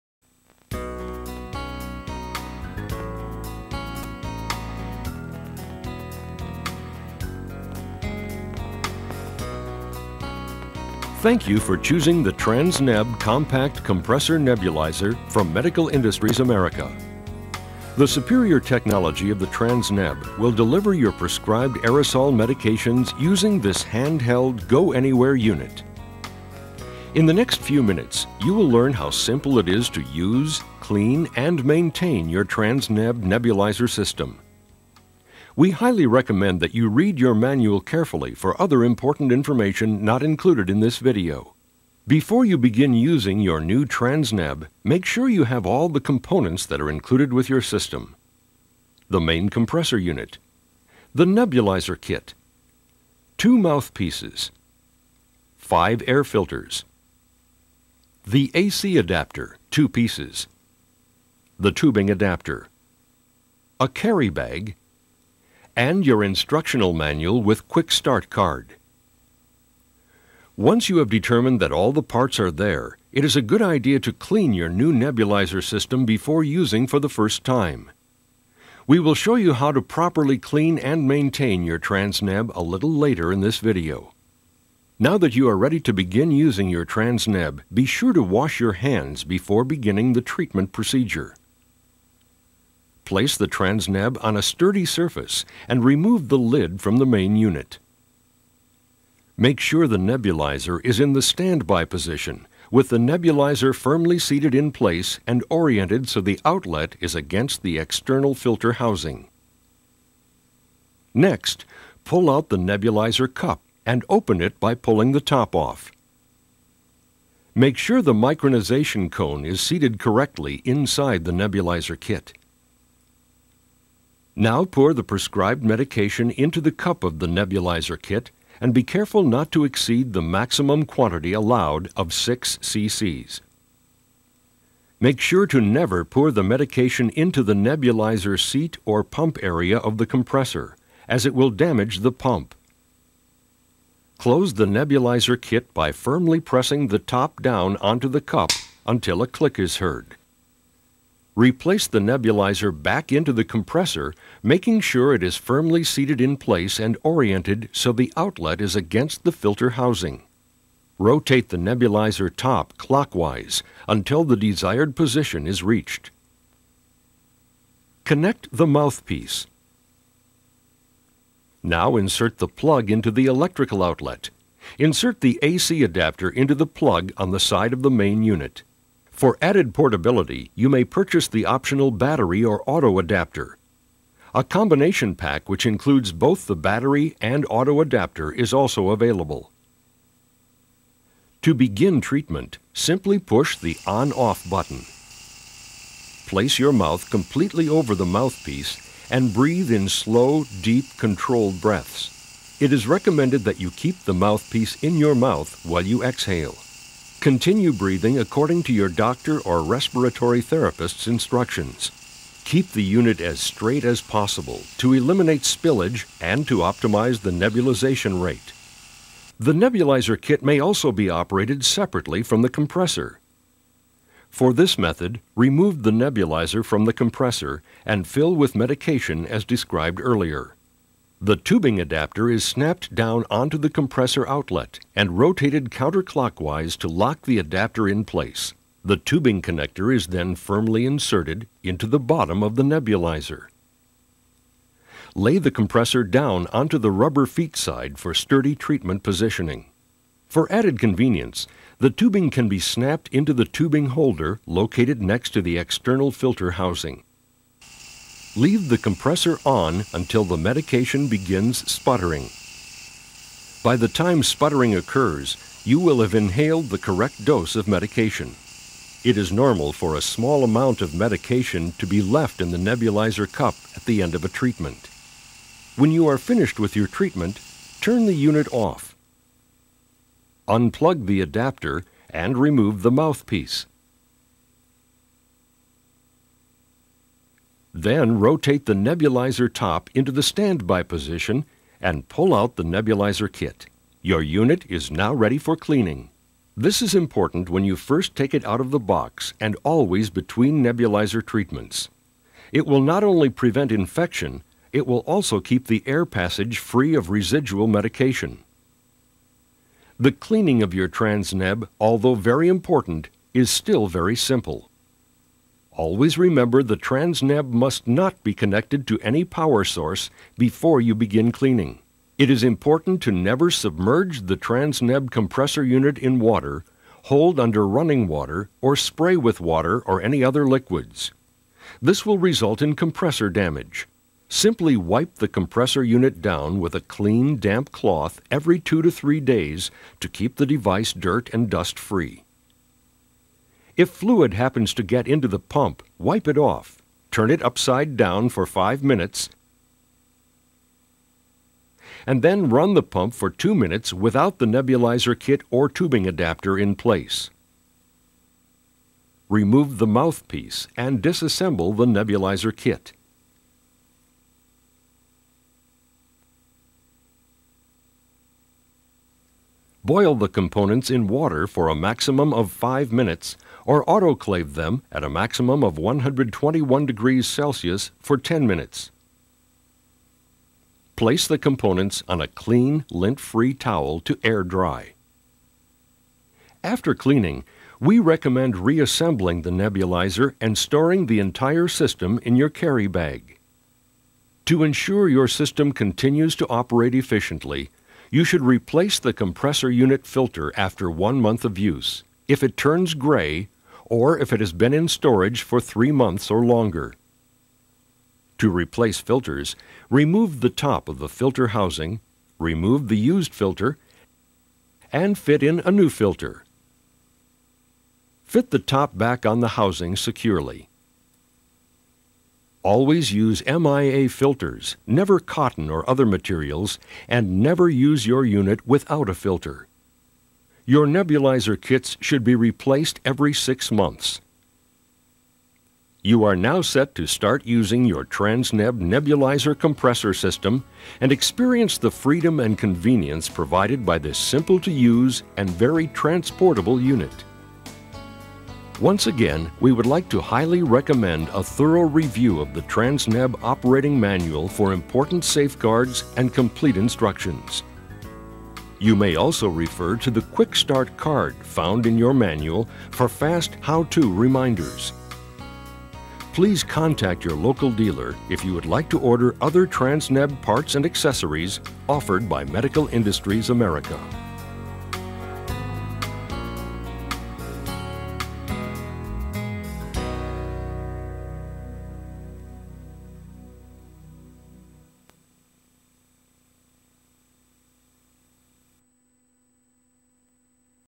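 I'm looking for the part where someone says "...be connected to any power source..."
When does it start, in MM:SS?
05:18.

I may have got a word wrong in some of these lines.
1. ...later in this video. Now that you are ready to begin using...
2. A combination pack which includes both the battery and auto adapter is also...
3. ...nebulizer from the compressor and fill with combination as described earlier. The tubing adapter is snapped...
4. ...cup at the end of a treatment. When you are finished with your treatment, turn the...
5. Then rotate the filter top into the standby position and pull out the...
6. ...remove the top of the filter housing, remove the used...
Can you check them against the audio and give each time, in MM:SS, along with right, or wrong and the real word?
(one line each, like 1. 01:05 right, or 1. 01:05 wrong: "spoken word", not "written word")
1. 01:22 right
2. 03:04 right
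3. 03:45 wrong: "medication", not "combination"
4. 04:33 right
5. 04:47 wrong: "nebulizer", not "filter"
6. 06:49 right.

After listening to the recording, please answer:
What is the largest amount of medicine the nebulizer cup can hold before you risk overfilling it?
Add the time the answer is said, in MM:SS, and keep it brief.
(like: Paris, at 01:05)
6 cc, at 02:12.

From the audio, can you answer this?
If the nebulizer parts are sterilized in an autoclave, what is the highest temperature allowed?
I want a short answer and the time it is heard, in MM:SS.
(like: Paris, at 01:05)
121 degrees Celsius, at 06:15.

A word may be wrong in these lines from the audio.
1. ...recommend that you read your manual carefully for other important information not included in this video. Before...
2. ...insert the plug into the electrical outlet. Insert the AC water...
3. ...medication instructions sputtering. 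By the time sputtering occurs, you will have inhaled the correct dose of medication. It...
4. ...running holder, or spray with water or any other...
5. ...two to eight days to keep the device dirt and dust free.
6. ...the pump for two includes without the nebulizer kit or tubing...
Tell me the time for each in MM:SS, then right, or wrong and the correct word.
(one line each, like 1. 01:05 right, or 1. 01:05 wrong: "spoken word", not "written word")
1. 00:36 right
2. 02:51 wrong: "adapter", not "water"
3. 04:20 wrong: "begins", not "instructions"
4. 05:27 wrong: "water", not "holder"
5. 05:38 wrong: "three", not "eight"
6. 05:52 wrong: "minutes", not "includes".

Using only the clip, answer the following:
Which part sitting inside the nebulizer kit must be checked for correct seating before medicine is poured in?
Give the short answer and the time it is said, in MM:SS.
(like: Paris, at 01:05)
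micronization cone, at 01:58.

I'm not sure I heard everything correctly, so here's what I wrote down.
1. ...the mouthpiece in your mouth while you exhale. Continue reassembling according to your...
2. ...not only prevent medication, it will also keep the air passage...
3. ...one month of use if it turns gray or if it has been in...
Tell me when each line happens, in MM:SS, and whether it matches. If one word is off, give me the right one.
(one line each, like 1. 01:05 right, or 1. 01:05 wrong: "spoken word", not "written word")
1. 03:24 wrong: "breathing", not "reassembling"
2. 05:02 wrong: "infection", not "medication"
3. 06:40 right.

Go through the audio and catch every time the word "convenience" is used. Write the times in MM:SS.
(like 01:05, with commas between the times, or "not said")
04:10, 07:22.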